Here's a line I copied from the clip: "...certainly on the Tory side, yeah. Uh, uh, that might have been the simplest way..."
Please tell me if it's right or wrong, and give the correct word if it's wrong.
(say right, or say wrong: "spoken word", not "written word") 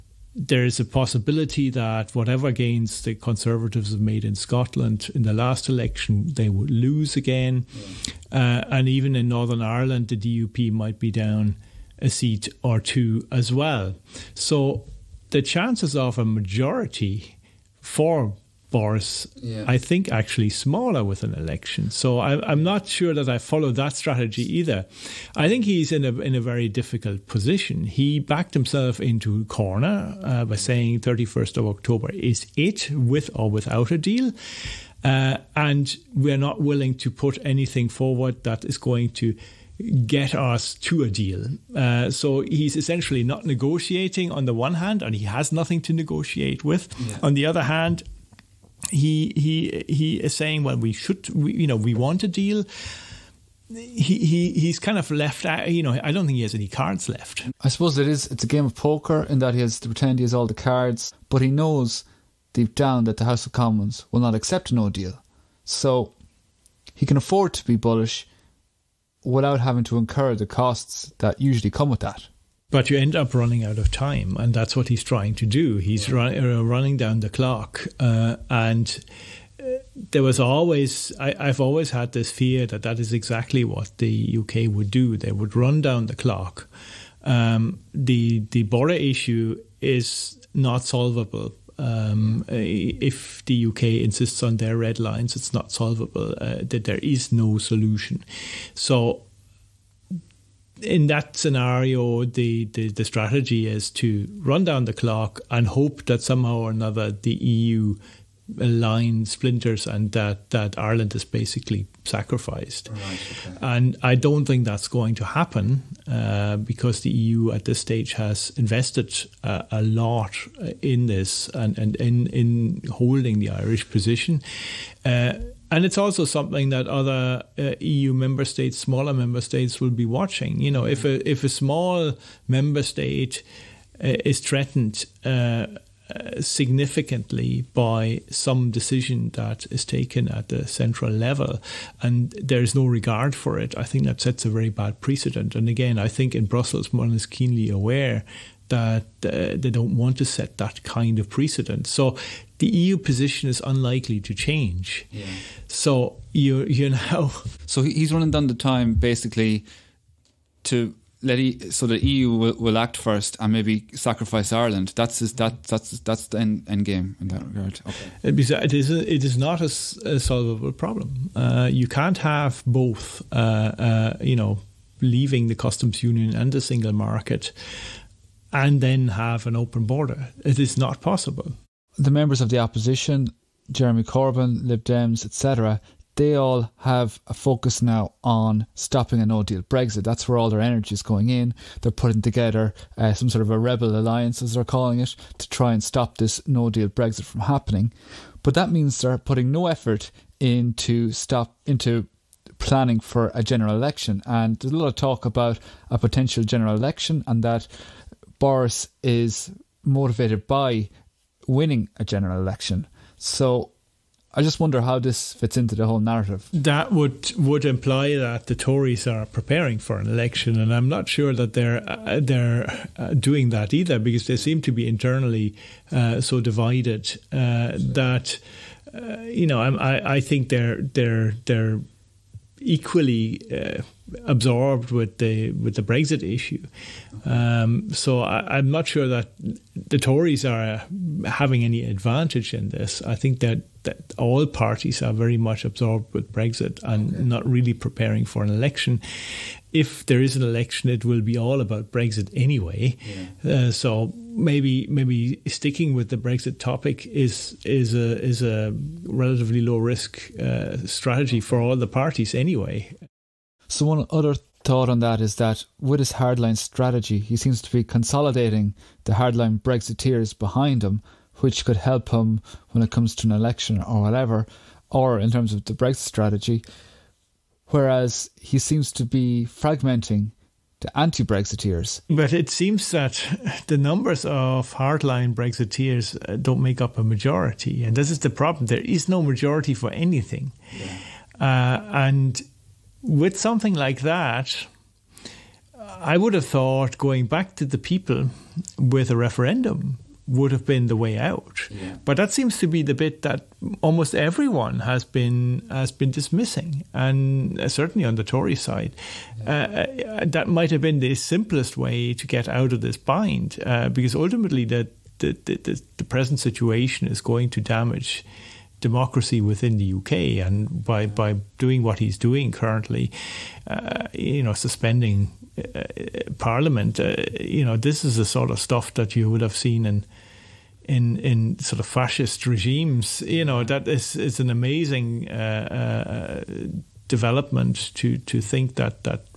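right.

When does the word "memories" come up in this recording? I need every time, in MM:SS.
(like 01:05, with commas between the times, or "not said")
not said.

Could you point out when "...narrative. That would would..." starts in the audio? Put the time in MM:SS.
03:35.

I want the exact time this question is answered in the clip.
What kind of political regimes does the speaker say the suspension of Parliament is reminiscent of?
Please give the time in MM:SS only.
05:31.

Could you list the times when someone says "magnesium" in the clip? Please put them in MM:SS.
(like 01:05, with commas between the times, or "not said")
not said.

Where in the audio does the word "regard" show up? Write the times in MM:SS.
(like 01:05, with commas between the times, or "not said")
02:22, 02:47.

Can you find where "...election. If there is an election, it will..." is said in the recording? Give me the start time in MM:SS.
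04:08.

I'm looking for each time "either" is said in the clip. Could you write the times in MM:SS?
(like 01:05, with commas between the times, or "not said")
00:24, 03:43.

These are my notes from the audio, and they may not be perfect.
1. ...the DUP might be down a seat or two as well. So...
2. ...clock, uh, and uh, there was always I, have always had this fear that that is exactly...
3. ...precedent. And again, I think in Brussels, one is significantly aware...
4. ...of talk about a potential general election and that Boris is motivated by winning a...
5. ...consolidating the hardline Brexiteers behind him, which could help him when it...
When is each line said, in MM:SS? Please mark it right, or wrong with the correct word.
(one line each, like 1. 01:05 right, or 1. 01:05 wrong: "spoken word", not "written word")
1. 00:10 right
2. 01:17 right
3. 02:24 wrong: "keenly", not "significantly"
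4. 03:24 right
5. 04:27 right.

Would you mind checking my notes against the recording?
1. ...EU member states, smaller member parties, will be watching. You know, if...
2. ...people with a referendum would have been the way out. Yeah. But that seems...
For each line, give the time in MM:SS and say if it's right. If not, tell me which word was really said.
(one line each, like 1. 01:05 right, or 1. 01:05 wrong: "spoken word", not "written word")
1. 02:07 wrong: "states", not "parties"
2. 04:57 right.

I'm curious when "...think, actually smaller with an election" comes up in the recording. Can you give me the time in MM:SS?
00:19.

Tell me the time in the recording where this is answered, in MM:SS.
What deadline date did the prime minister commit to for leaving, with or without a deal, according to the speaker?
00:31.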